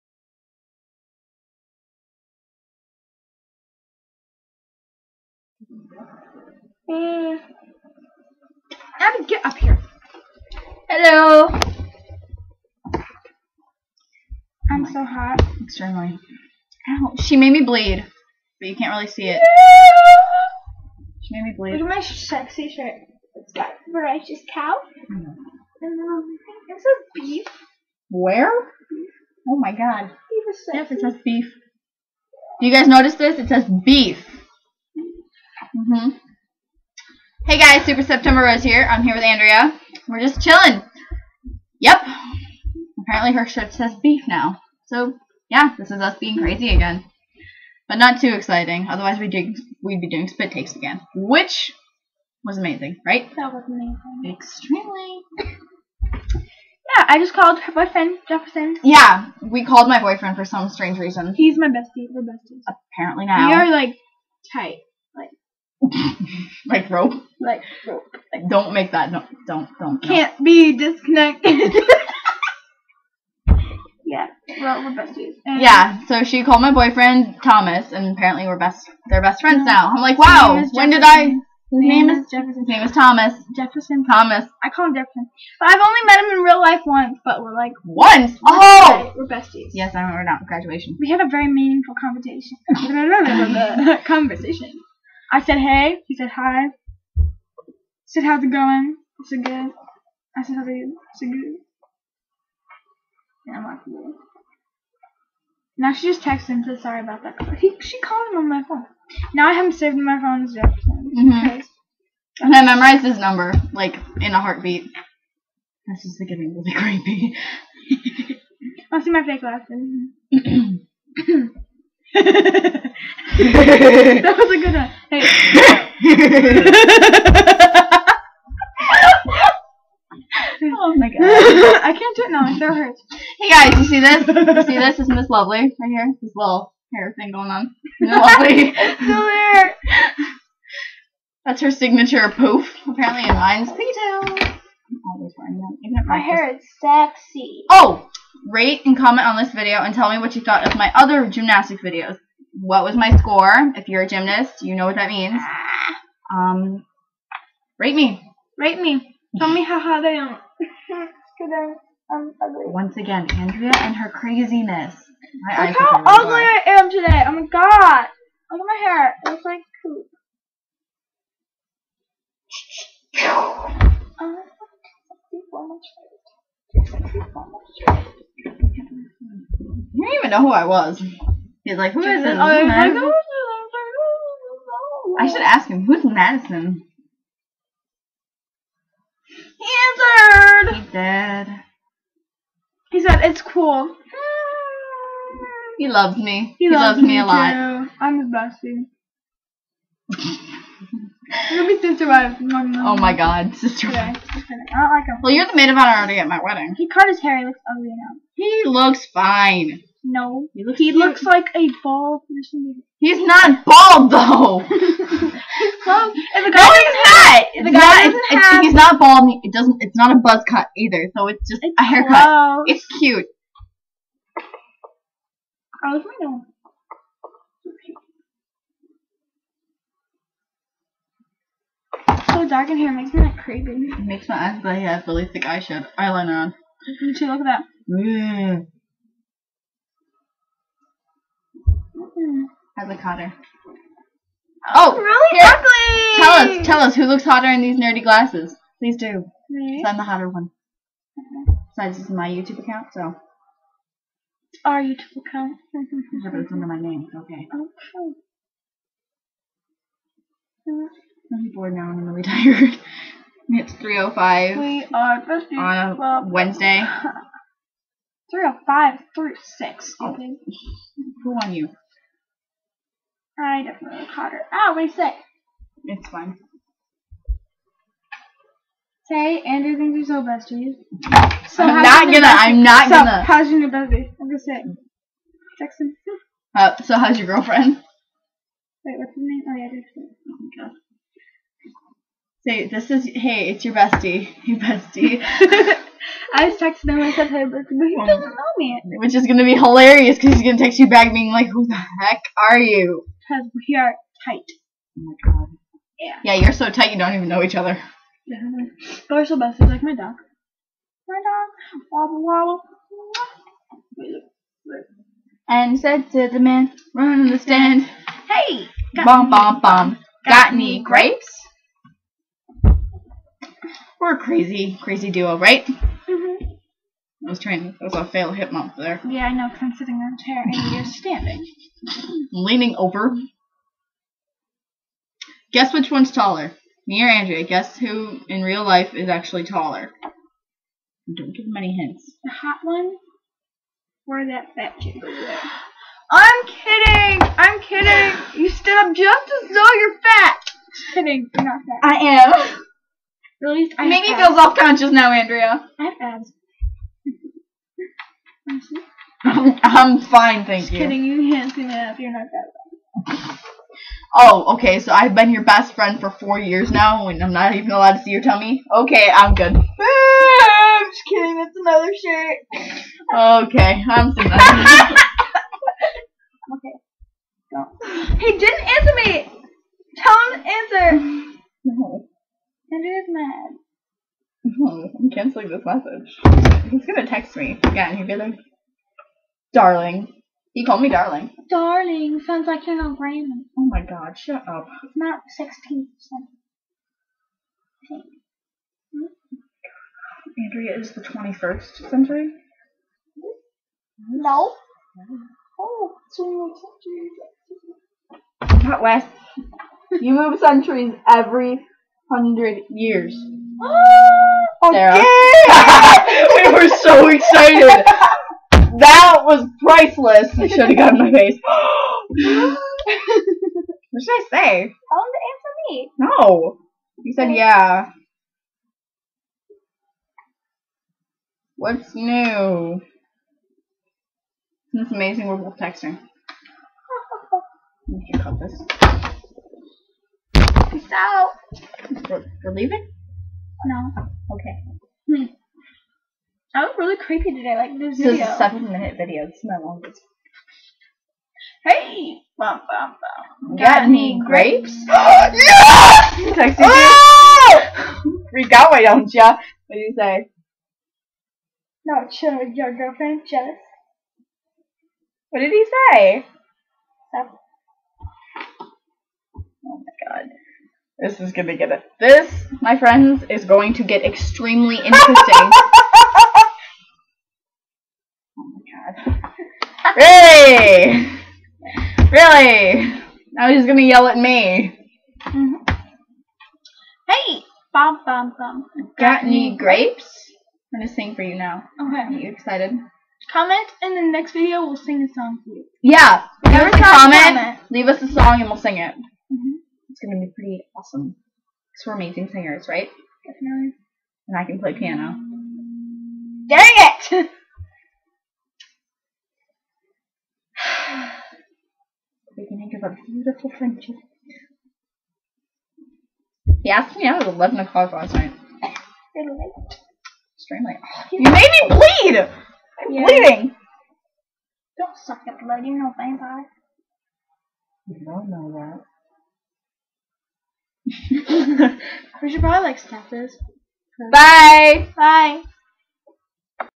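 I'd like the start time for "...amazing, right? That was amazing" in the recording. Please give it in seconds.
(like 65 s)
52 s.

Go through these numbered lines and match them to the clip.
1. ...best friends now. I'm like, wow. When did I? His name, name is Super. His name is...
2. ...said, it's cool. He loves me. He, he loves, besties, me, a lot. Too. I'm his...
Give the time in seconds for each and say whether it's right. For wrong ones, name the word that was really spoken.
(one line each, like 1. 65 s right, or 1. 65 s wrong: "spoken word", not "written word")
1. 79 s wrong: "Jefferson", not "Super"
2. 193 s wrong: "loves", not "besties".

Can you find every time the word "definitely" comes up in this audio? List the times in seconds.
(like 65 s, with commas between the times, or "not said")
273 s, 503 s.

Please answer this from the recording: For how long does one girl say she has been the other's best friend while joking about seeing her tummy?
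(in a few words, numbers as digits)
4 years.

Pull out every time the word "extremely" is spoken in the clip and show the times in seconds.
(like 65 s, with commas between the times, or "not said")
15 s, 54 s, 474 s, 520 s.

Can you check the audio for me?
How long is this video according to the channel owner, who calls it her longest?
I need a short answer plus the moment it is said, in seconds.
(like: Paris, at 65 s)
7 minutes, at 448 s.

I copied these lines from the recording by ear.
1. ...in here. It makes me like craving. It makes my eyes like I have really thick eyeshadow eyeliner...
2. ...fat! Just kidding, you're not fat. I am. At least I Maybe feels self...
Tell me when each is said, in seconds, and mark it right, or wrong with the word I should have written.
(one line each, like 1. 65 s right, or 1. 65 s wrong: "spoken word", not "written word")
1. 232 s right
2. 350 s right.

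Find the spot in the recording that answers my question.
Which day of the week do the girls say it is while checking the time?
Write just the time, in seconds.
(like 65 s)
266 s.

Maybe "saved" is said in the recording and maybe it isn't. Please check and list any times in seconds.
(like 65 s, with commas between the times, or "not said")
109 s.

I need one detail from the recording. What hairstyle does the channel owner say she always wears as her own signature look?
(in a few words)
Pigtails.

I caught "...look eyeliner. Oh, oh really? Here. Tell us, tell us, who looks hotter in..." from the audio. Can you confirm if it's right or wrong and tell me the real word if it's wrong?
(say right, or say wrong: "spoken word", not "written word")
wrong: "hotter", not "eyeliner".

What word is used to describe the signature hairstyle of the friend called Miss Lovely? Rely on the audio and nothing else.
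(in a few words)
Poof.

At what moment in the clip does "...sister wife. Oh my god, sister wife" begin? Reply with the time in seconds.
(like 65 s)
201 s.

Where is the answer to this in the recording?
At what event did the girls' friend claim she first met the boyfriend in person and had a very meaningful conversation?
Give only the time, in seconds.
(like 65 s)
90 s.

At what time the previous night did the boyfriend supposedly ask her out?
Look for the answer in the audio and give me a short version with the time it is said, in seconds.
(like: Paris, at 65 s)
11 o'clock, at 517 s.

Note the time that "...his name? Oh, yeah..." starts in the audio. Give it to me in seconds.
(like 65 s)
289 s.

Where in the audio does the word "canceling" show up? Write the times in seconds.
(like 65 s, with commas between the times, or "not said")
385 s.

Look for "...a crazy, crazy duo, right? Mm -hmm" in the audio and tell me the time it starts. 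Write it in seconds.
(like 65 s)
324 s.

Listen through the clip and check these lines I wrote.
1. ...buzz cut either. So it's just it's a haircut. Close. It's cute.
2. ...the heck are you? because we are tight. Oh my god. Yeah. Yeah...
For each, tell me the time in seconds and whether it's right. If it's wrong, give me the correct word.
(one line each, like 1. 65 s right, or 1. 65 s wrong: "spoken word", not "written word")
1. 220 s right
2. 301 s right.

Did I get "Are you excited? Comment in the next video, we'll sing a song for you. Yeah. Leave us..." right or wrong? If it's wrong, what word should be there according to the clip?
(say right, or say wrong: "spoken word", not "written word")
right.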